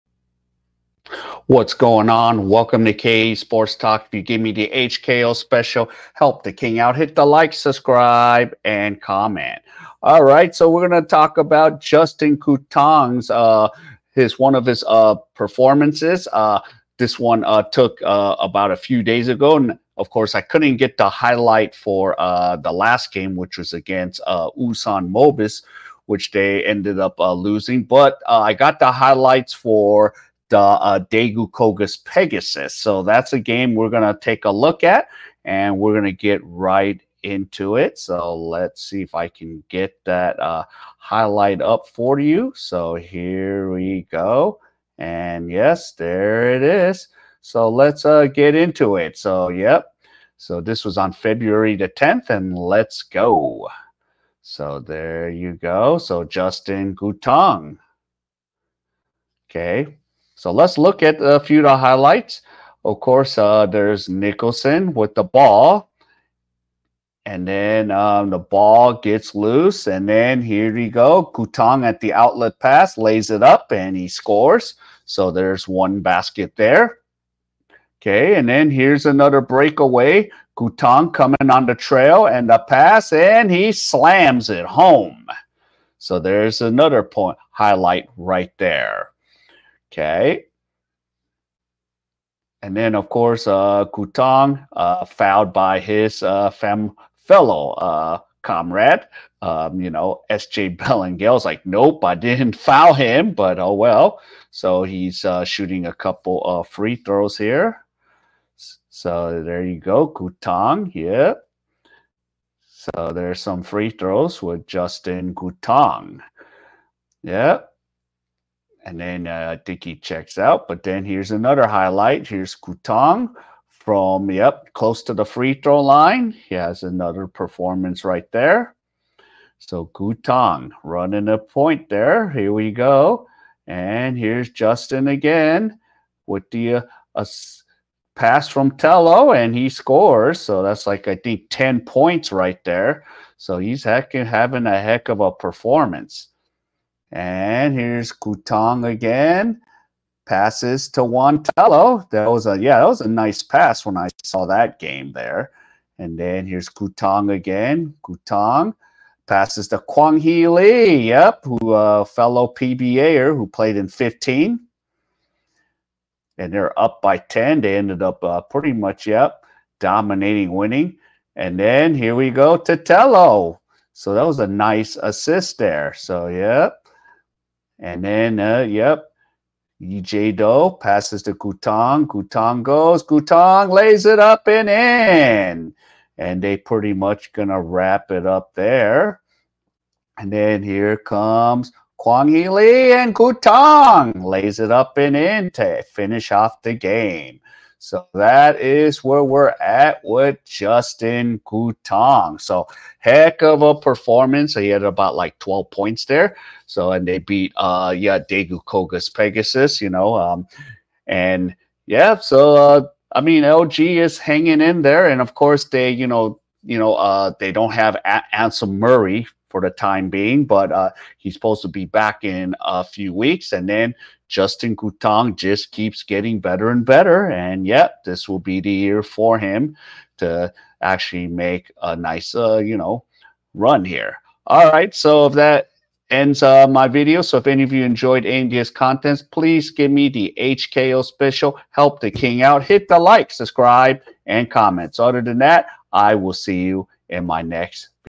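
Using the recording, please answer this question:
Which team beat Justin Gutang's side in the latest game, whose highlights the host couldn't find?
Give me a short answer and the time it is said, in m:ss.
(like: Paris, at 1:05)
Ulsan Mobis, at 0:24.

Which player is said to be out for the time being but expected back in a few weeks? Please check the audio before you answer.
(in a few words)
Asem Marei.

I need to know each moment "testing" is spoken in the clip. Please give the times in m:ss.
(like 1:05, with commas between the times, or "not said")
not said.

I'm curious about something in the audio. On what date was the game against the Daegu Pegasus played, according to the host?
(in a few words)
February 10.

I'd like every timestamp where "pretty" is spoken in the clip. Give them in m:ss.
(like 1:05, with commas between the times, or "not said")
2:48, 3:06.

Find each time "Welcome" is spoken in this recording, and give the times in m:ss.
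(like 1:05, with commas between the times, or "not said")
0:02.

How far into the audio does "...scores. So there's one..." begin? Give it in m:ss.
1:14.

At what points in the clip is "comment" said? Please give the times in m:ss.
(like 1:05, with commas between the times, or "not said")
0:09, 4:04.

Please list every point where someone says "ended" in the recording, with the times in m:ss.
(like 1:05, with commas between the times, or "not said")
0:26, 2:47.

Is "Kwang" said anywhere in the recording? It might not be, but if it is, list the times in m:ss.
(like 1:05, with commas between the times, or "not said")
2:39, 3:11.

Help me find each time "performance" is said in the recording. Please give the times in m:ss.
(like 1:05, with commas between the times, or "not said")
0:15, 2:07, 2:25, 3:23.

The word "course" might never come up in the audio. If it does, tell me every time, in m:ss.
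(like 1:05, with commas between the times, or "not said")
0:20, 1:02, 1:33, 3:35.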